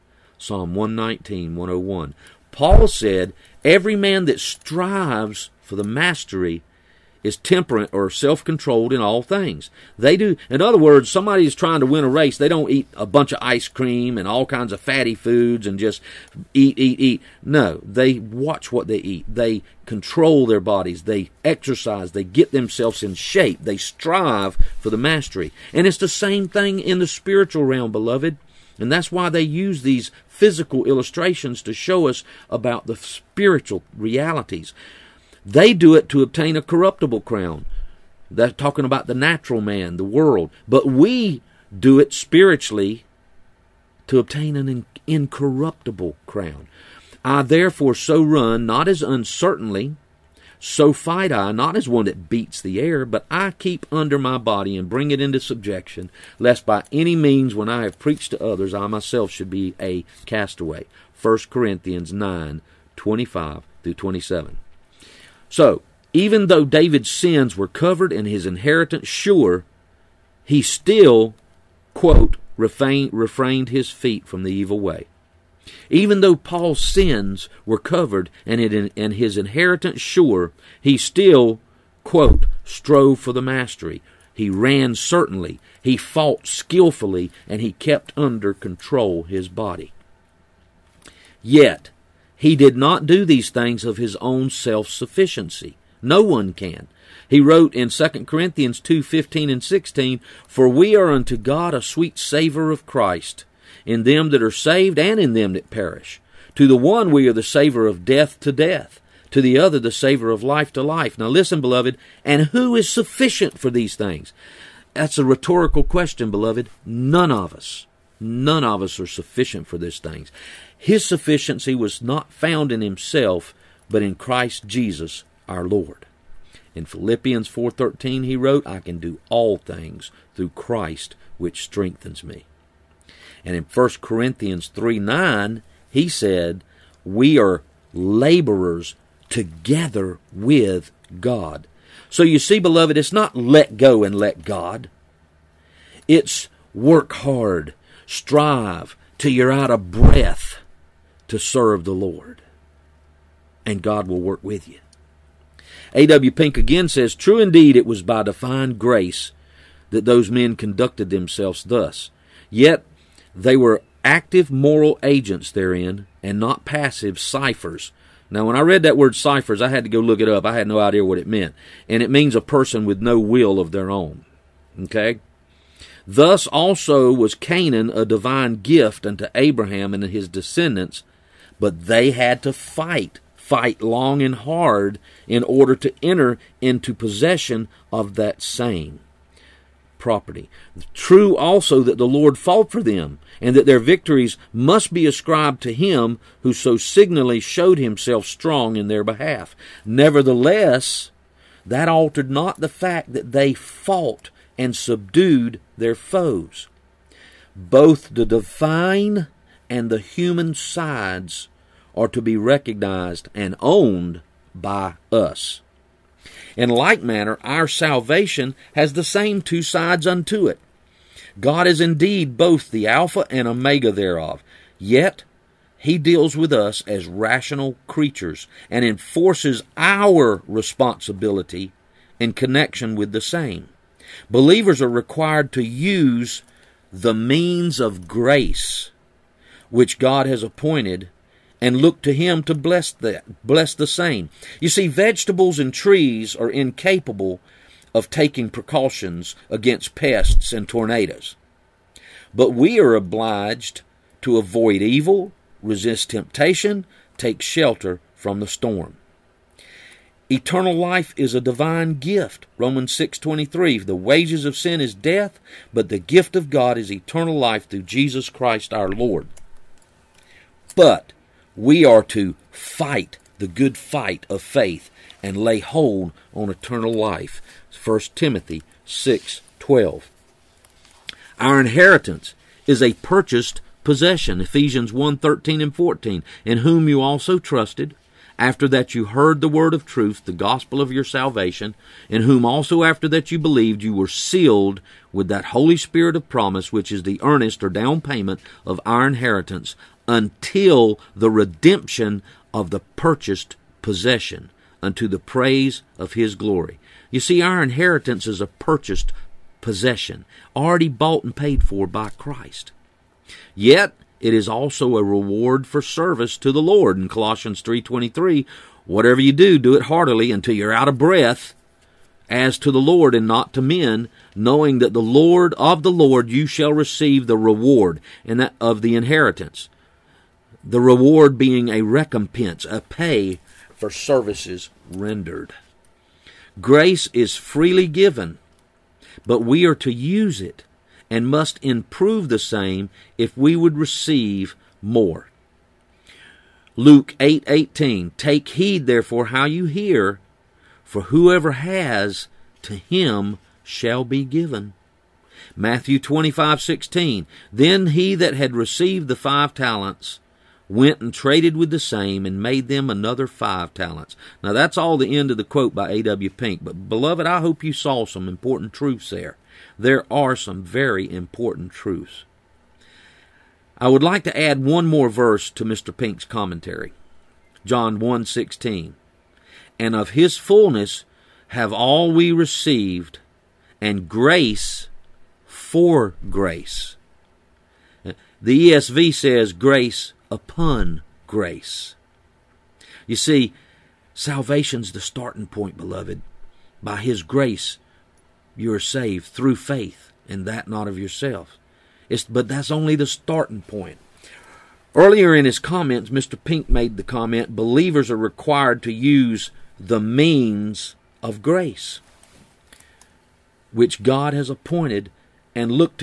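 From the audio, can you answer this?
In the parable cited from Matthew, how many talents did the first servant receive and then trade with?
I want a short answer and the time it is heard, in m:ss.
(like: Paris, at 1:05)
5, at 5:59.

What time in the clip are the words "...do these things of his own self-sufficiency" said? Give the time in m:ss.
1:33.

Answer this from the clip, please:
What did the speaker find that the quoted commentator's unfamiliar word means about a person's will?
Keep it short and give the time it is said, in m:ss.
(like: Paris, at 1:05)
a person with no will of their own, at 2:52.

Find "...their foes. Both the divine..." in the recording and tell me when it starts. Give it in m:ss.
3:25.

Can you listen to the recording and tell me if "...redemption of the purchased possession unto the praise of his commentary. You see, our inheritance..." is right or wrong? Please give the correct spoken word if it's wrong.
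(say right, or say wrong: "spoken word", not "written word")
wrong: "glory", not "commentary".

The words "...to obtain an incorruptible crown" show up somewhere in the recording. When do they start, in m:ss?
0:44.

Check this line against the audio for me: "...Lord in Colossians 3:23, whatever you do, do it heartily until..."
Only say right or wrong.
right.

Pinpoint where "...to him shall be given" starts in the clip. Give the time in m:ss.
5:52.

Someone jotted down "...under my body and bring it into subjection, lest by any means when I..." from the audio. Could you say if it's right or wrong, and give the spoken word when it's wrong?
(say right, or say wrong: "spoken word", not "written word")
right.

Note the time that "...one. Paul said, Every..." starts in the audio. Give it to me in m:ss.
0:01.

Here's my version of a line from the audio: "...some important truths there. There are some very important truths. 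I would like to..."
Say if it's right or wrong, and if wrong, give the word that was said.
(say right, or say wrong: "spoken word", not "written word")
right.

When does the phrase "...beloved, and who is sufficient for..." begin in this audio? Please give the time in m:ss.
1:51.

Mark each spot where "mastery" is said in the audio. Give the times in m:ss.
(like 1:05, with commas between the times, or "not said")
0:05, 0:24, 1:23.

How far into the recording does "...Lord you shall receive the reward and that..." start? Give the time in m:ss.
5:25.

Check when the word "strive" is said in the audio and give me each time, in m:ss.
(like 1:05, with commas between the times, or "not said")
0:04, 0:23, 2:28.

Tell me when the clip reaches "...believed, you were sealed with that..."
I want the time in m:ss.
4:53.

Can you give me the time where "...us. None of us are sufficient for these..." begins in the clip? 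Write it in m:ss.
1:57.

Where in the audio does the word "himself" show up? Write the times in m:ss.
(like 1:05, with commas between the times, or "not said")
2:02, 3:17.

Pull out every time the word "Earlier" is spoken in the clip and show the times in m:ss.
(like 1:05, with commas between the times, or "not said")
6:44.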